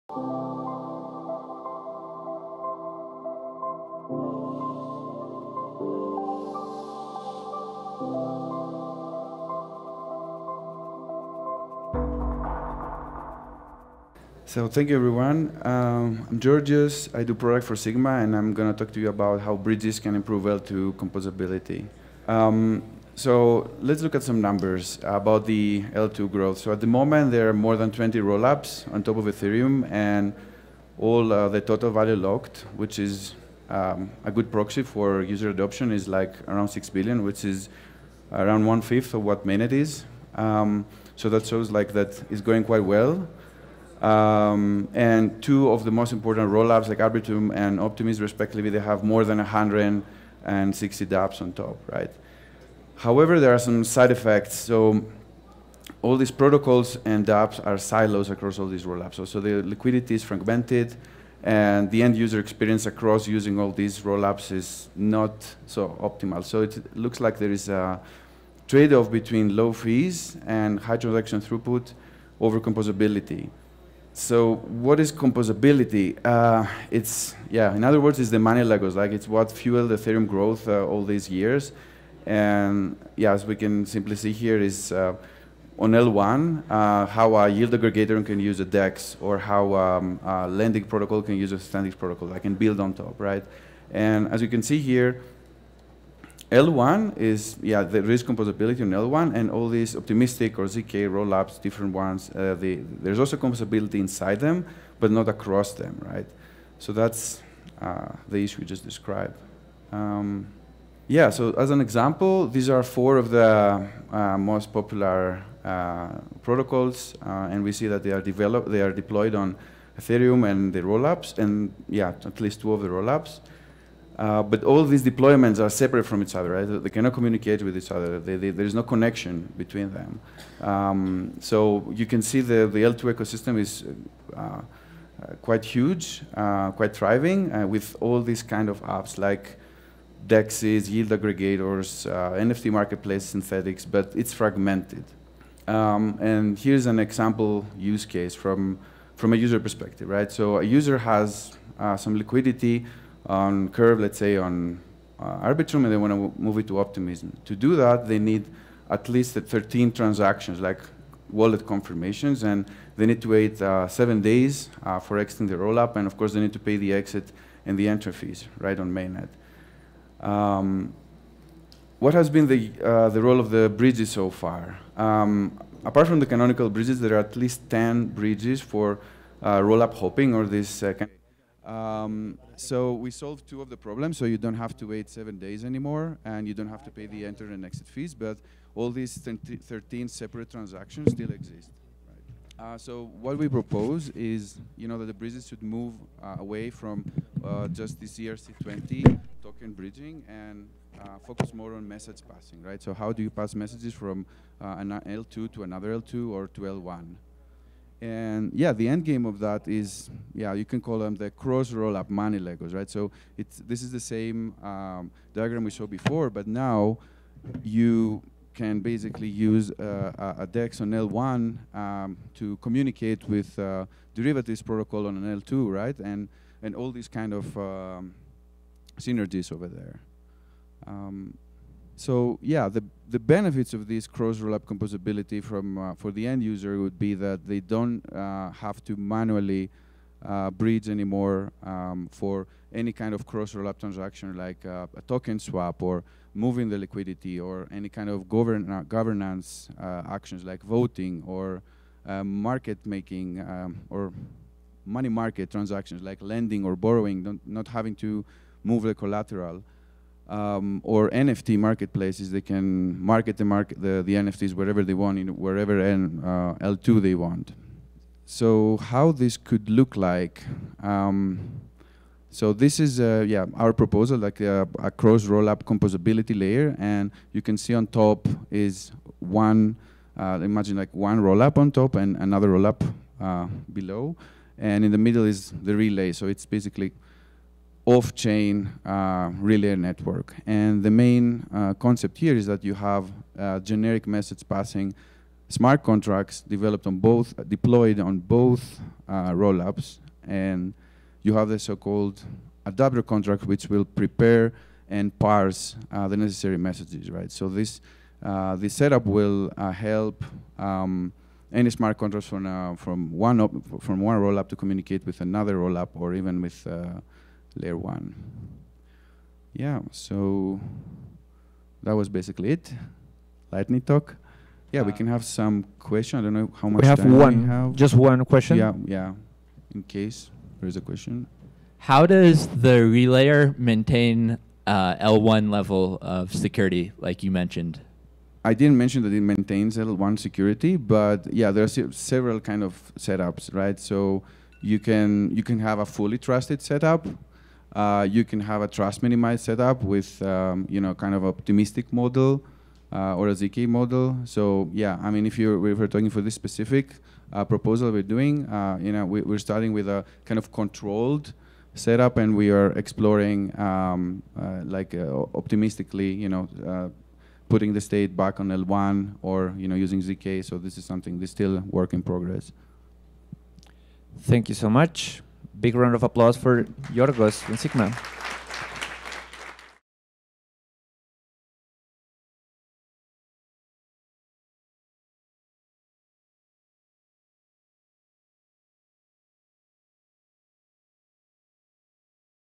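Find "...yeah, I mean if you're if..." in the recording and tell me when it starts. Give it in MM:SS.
05:54.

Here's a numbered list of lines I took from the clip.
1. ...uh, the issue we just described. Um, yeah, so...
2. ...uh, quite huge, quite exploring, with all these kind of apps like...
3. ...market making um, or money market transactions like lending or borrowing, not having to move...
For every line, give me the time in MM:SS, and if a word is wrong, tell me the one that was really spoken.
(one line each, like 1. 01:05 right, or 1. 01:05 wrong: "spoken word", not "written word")
1. 01:47 right
2. 02:14 wrong: "thriving", not "exploring"
3. 04:12 right.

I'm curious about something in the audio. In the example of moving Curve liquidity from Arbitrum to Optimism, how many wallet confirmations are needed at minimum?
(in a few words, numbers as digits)
13.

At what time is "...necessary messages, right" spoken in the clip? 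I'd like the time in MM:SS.
05:06.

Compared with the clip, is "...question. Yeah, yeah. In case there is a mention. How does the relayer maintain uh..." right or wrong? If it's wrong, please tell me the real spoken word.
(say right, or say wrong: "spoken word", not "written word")
wrong: "question", not "mention".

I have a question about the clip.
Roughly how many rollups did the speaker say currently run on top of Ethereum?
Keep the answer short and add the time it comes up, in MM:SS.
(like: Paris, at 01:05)
more than 20, at 00:27.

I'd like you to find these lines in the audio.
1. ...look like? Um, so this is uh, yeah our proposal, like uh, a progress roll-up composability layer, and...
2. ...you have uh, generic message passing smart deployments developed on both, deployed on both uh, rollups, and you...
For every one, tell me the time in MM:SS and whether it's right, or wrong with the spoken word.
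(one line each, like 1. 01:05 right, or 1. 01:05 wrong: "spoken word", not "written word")
1. 04:29 wrong: "cross", not "progress"
2. 04:52 wrong: "contracts", not "deployments".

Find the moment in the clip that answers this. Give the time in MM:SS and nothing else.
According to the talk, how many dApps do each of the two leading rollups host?
00:49.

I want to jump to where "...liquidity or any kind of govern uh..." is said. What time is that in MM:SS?
04:06.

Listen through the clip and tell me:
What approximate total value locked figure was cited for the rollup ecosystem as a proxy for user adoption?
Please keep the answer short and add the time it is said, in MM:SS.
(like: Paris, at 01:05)
6 billion, at 00:36.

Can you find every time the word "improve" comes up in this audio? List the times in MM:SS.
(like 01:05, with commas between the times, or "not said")
00:20.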